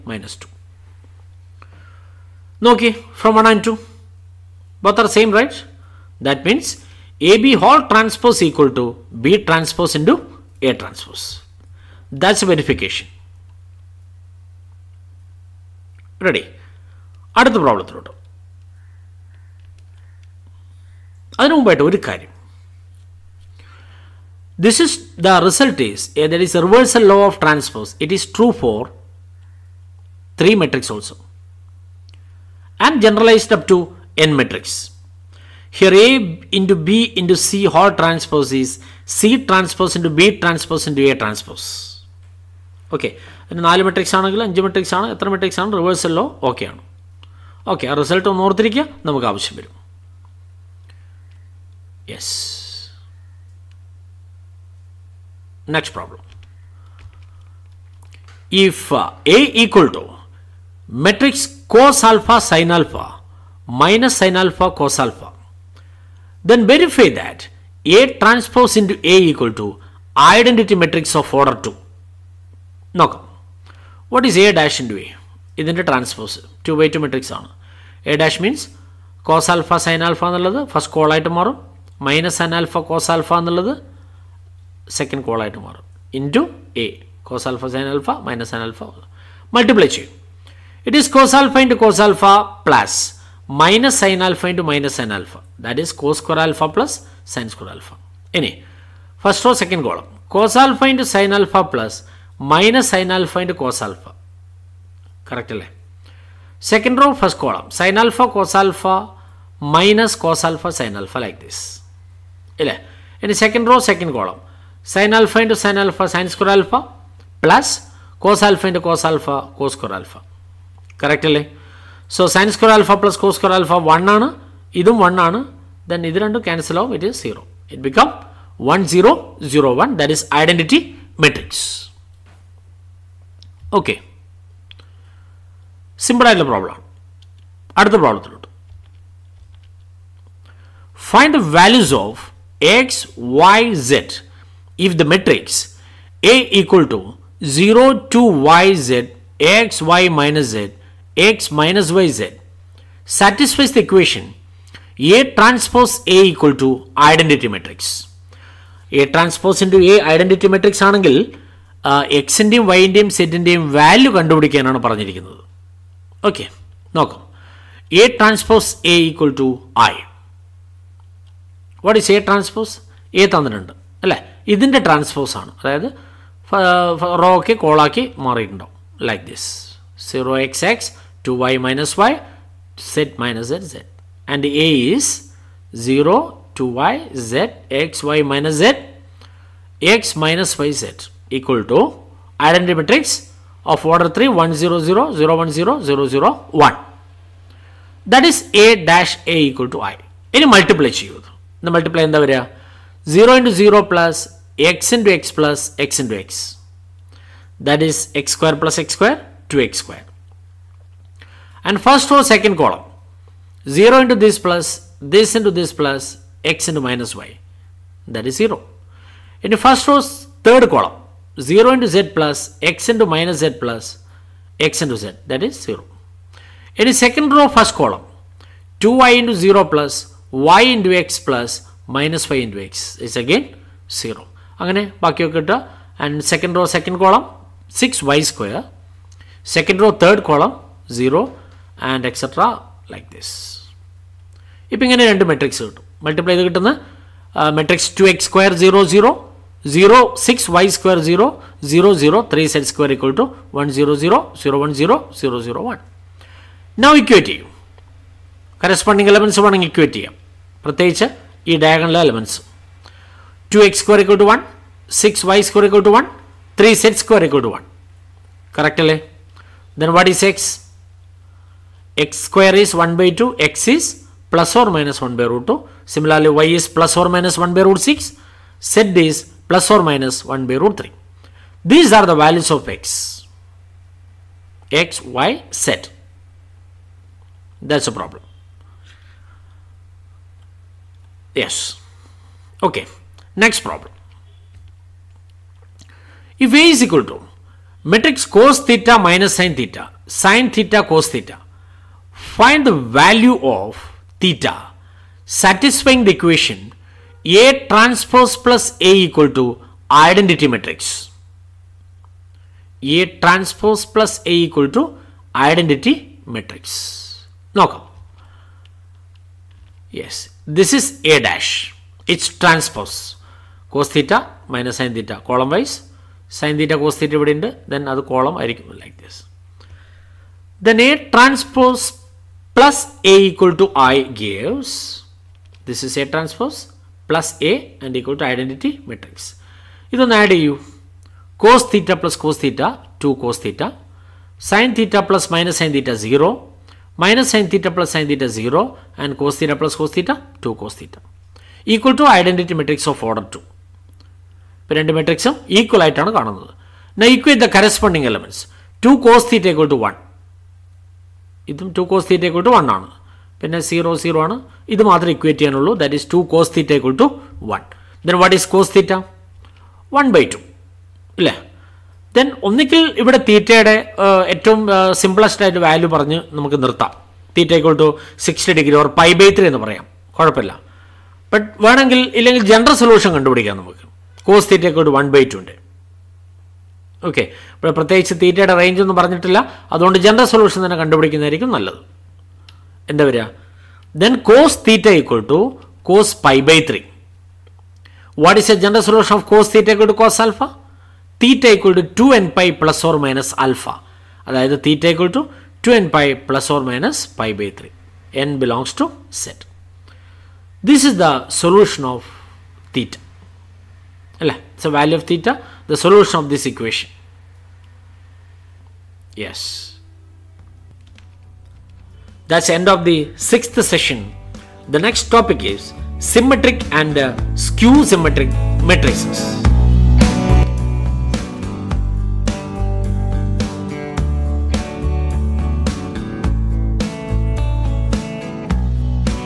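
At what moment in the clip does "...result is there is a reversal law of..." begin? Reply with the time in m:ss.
0:25.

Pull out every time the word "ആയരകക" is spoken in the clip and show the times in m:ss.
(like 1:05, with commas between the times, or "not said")
5:28.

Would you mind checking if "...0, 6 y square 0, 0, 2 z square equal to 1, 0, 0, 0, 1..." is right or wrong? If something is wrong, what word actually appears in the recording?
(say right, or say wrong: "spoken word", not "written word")
wrong: "3", not "2".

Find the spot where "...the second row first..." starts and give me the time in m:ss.
3:46.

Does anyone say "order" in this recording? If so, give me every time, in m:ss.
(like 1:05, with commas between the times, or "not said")
1:11, 3:13, 5:53.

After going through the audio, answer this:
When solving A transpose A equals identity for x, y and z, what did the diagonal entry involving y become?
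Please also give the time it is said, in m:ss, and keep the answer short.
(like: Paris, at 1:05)
6y squared, at 3:57.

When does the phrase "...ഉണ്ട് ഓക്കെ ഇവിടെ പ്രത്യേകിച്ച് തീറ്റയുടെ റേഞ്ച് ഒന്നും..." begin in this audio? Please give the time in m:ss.
6:25.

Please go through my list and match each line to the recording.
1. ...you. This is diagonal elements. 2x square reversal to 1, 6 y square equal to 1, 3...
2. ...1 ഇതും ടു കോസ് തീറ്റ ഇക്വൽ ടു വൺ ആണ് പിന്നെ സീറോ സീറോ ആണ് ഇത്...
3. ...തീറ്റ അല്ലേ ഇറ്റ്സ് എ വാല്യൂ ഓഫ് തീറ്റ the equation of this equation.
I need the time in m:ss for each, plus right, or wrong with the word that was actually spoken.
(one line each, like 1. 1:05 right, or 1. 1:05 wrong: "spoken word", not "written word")
1. 4:19 wrong: "equal", not "reversal"
2. 5:59 right
3. 6:52 wrong: "solution", not "equation".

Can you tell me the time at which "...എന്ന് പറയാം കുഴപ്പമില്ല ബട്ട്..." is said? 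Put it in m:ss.
6:19.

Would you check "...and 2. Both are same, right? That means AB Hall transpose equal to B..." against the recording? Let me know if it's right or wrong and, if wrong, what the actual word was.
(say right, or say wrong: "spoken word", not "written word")
right.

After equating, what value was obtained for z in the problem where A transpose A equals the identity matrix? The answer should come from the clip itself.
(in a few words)
plus or minus 1 by root 3.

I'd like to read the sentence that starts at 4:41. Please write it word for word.
These are the values of x, x, y, z.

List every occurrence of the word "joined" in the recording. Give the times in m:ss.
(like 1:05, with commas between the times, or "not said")
not said.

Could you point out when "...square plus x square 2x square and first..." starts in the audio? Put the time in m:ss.
3:28.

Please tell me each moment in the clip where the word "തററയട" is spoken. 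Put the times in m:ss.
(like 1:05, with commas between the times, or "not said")
6:13, 6:28.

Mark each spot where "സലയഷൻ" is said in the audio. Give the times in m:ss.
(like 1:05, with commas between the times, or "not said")
6:22, 6:30, 6:38, 6:51.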